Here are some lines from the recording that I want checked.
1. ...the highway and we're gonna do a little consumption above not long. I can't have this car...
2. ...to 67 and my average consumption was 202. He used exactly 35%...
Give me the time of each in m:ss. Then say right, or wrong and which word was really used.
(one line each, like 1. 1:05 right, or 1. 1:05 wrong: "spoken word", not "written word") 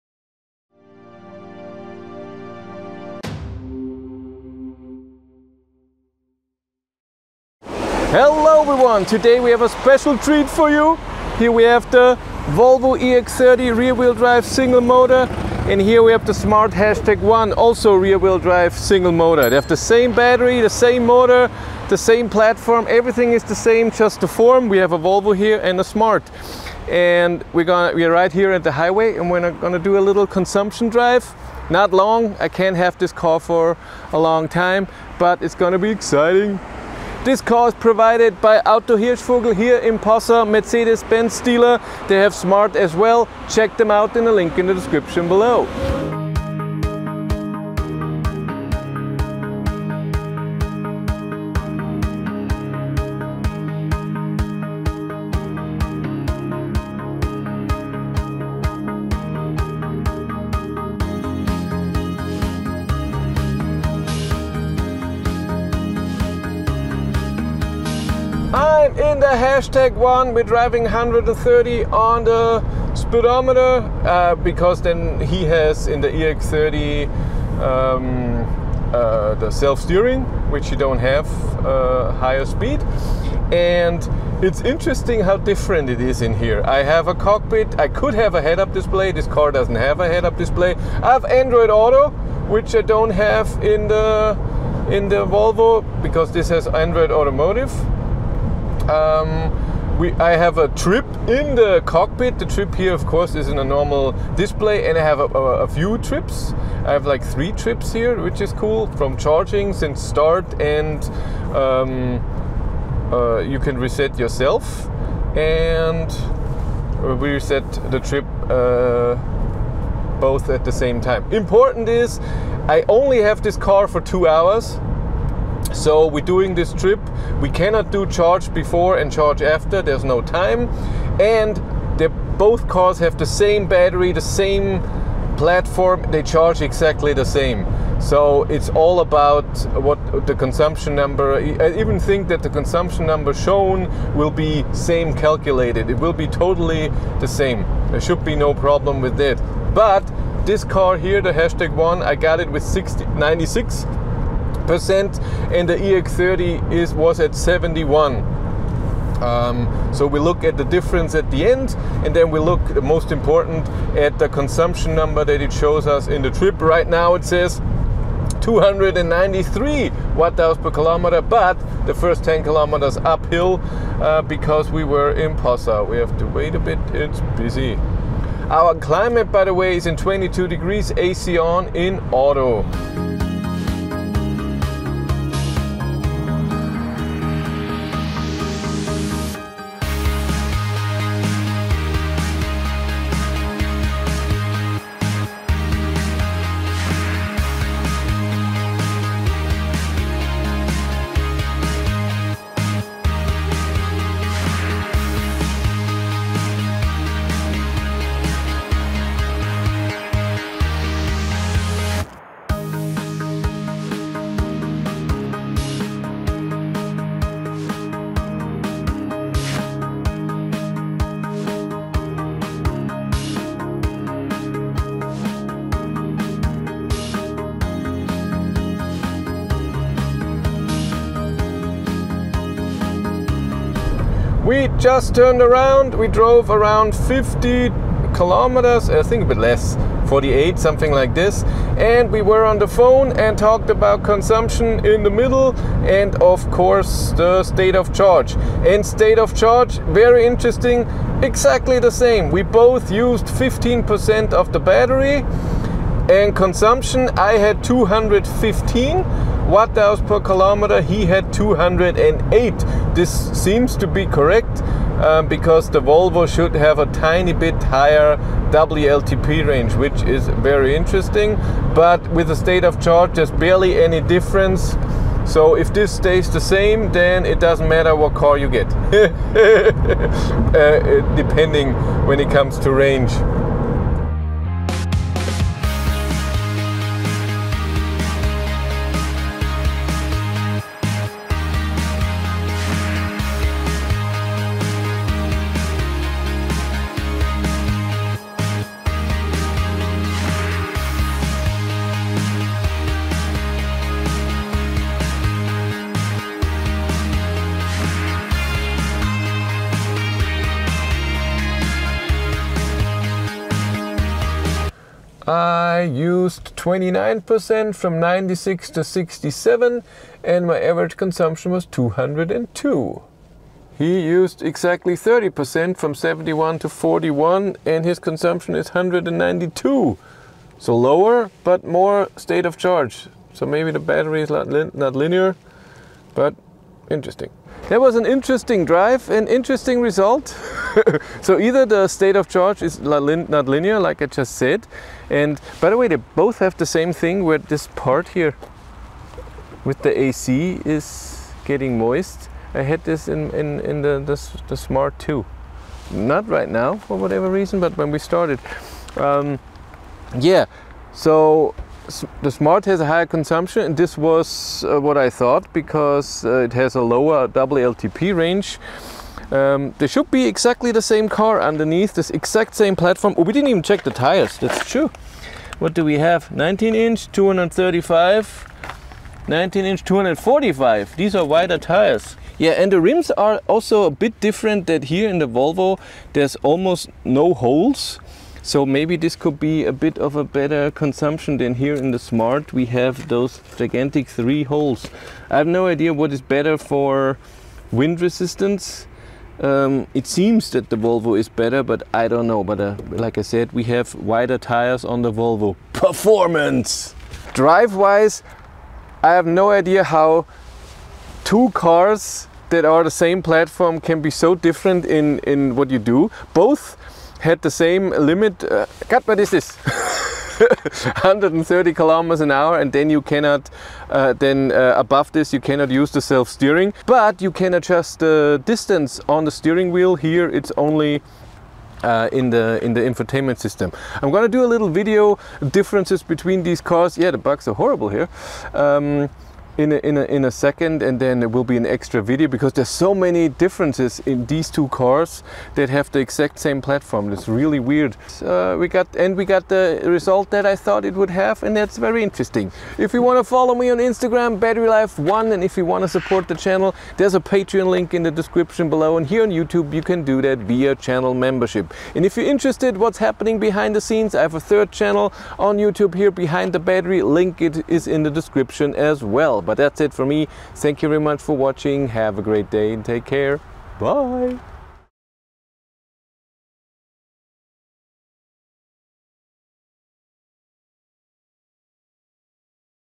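1. 0:28 wrong: "drive", not "above"
2. 5:18 wrong: "30", not "35".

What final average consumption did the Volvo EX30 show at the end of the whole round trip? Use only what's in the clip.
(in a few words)
192.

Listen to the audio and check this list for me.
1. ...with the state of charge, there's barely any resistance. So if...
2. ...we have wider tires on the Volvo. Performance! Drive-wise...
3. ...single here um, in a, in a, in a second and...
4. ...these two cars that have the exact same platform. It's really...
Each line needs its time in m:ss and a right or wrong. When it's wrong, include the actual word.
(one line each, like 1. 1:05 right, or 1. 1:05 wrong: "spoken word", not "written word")
1. 4:32 wrong: "difference", not "resistance"
2. 6:43 right
3. 7:17 wrong: "horrible", not "single"
4. 7:24 right.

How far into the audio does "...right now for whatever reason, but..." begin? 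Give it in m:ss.
5:56.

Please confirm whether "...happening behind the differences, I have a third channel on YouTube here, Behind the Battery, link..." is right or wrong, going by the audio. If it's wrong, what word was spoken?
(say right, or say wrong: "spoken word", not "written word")
wrong: "scenes", not "differences".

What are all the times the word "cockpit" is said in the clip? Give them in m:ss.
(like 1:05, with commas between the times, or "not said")
1:27, 1:41.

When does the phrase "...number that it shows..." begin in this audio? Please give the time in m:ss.
2:44.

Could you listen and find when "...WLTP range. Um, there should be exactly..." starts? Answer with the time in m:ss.
6:07.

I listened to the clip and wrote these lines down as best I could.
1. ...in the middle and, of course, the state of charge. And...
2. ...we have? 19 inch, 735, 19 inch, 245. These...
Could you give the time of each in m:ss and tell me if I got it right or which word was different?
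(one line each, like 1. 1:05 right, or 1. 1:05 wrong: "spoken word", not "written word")
1. 4:04 right
2. 6:15 wrong: "235", not "735".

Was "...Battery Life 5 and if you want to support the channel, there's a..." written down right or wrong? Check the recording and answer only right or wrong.
wrong.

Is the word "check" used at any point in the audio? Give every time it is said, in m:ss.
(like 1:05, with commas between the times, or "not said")
0:43, 6:13.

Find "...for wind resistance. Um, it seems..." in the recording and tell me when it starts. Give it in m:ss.
6:36.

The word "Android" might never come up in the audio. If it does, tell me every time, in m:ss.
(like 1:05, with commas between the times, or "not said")
1:31, 1:36.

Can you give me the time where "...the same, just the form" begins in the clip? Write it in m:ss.
0:23.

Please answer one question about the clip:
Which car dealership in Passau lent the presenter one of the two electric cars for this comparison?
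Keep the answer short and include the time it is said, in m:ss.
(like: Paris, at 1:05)
Auto Hirschvogel, at 0:38.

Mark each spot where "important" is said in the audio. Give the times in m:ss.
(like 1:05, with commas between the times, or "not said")
2:01, 2:43.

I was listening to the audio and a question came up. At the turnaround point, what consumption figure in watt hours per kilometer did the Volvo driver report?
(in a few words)
208.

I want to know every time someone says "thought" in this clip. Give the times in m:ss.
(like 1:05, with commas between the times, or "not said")
6:05, 7:30.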